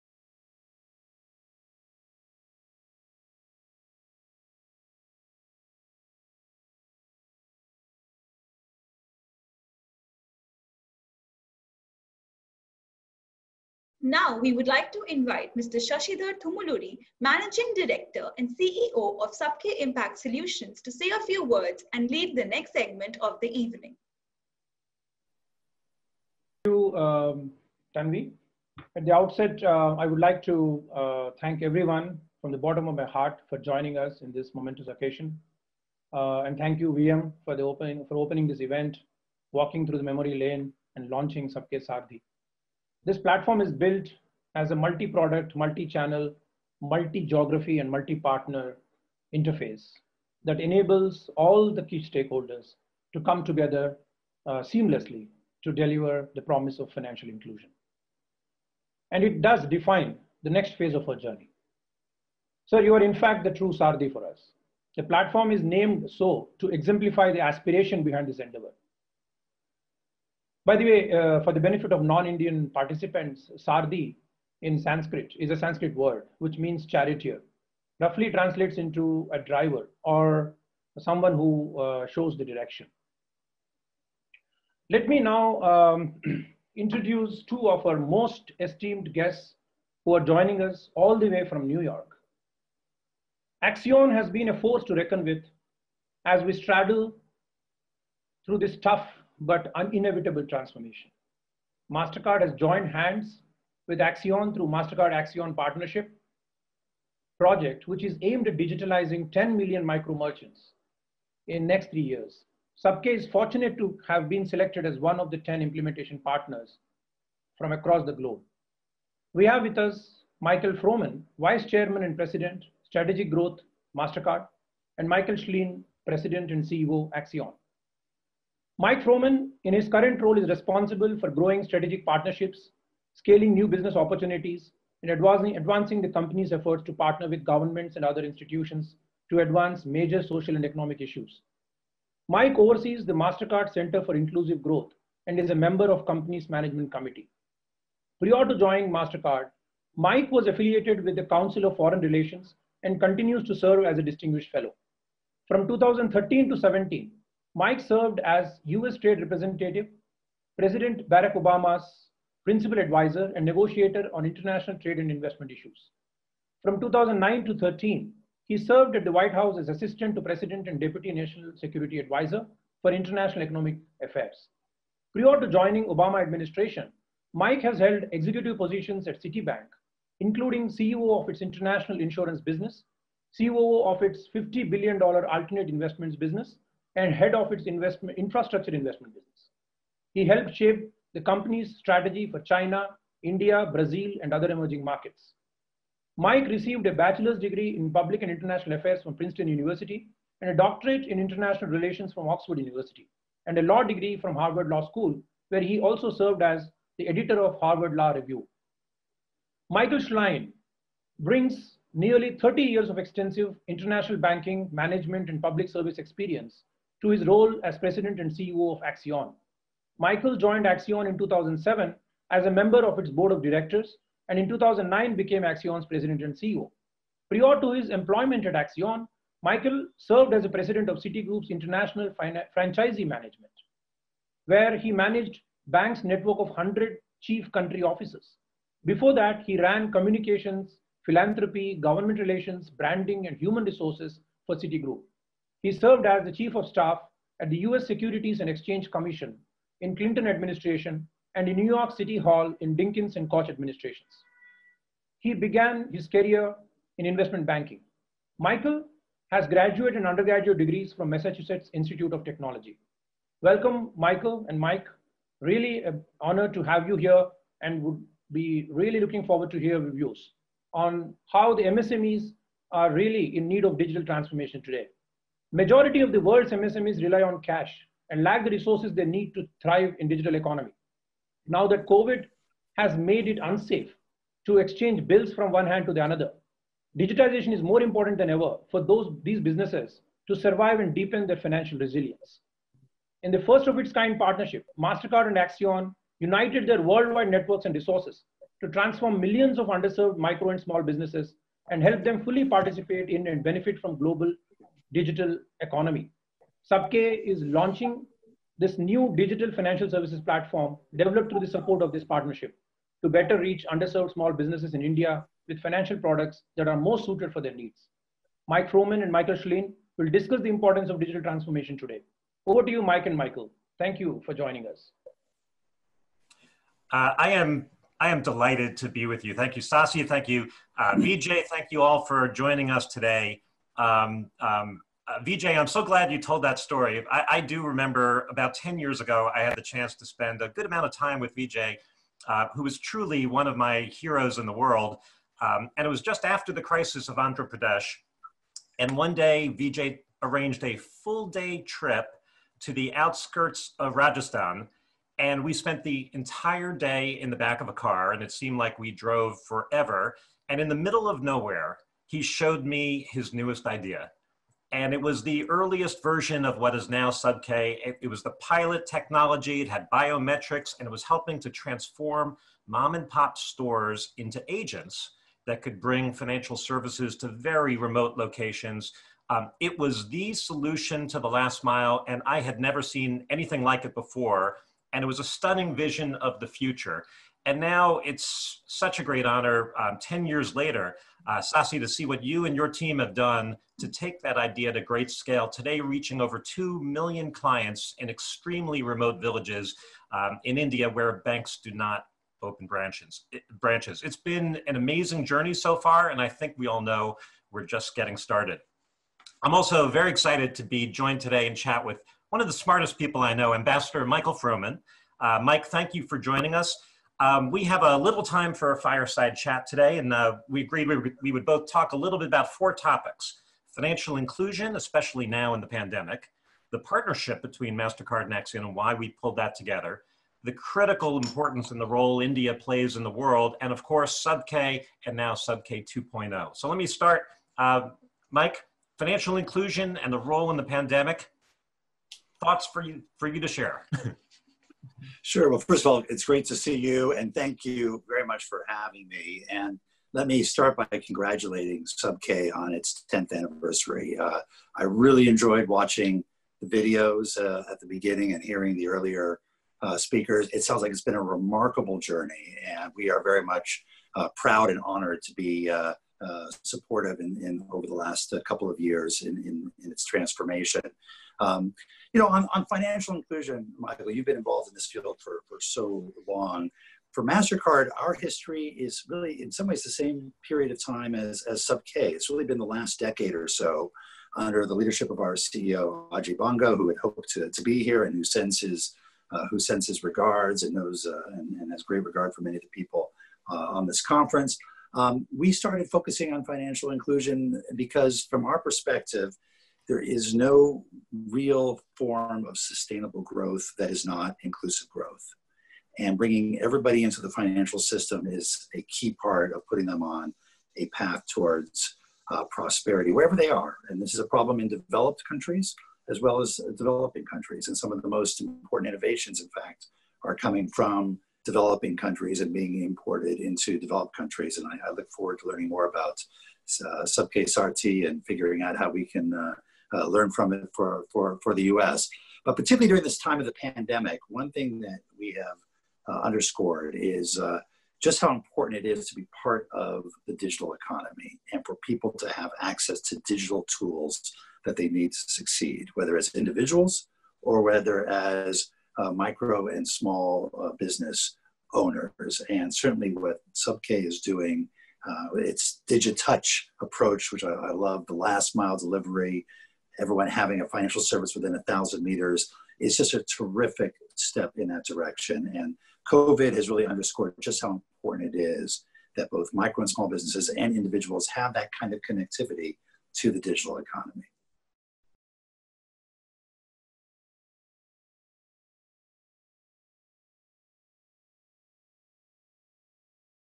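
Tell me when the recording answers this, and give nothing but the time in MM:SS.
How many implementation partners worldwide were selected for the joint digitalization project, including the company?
01:55.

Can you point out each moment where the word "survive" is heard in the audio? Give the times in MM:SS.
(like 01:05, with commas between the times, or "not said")
04:50.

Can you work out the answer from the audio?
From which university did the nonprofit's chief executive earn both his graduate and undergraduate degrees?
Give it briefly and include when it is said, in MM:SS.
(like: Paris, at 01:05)
Massachusetts Institute of Technology, at 04:21.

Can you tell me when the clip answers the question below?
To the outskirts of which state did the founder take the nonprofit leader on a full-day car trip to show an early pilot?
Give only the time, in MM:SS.
05:53.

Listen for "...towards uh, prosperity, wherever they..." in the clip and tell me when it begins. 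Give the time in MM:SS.
08:31.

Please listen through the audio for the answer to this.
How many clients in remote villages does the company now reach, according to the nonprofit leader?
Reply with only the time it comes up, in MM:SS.
06:36.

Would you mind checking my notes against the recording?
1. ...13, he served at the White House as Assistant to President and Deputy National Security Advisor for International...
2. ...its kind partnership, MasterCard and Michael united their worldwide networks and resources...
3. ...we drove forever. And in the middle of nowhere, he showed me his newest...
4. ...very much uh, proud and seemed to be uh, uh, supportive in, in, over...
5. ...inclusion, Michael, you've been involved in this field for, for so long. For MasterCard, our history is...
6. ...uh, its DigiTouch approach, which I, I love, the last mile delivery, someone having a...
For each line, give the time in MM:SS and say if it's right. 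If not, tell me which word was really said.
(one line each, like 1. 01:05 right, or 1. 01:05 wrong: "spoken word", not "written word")
1. 02:47 right
2. 04:53 wrong: "Accion", not "Michael"
3. 05:58 right
4. 07:43 wrong: "honored", not "seemed"
5. 07:53 right
6. 09:15 wrong: "everyone", not "someone".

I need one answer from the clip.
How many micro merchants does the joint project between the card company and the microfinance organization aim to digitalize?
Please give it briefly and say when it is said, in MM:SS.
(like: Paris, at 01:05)
10 million, at 01:49.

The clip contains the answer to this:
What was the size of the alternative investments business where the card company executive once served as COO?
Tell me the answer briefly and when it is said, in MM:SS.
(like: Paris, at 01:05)
$50 billion, at 03:04.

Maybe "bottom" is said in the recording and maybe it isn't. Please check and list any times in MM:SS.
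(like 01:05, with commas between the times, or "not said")
00:32.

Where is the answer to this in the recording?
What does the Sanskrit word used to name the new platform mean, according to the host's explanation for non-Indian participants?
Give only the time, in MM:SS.
01:16.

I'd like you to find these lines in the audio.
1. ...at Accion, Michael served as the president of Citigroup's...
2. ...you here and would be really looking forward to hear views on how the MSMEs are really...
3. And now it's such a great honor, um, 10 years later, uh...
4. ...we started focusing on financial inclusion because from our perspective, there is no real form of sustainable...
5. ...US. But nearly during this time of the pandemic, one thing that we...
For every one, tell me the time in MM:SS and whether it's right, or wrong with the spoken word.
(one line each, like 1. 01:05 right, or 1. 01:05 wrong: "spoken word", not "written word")
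1. 03:48 right
2. 04:26 right
3. 06:27 right
4. 08:15 right
5. 08:51 wrong: "particularly", not "nearly".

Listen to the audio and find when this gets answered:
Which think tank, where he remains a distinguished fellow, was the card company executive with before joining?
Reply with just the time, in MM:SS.
02:31.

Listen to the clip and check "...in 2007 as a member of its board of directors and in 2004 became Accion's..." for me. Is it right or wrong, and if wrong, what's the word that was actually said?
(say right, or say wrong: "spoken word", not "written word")
wrong: "2009", not "2004".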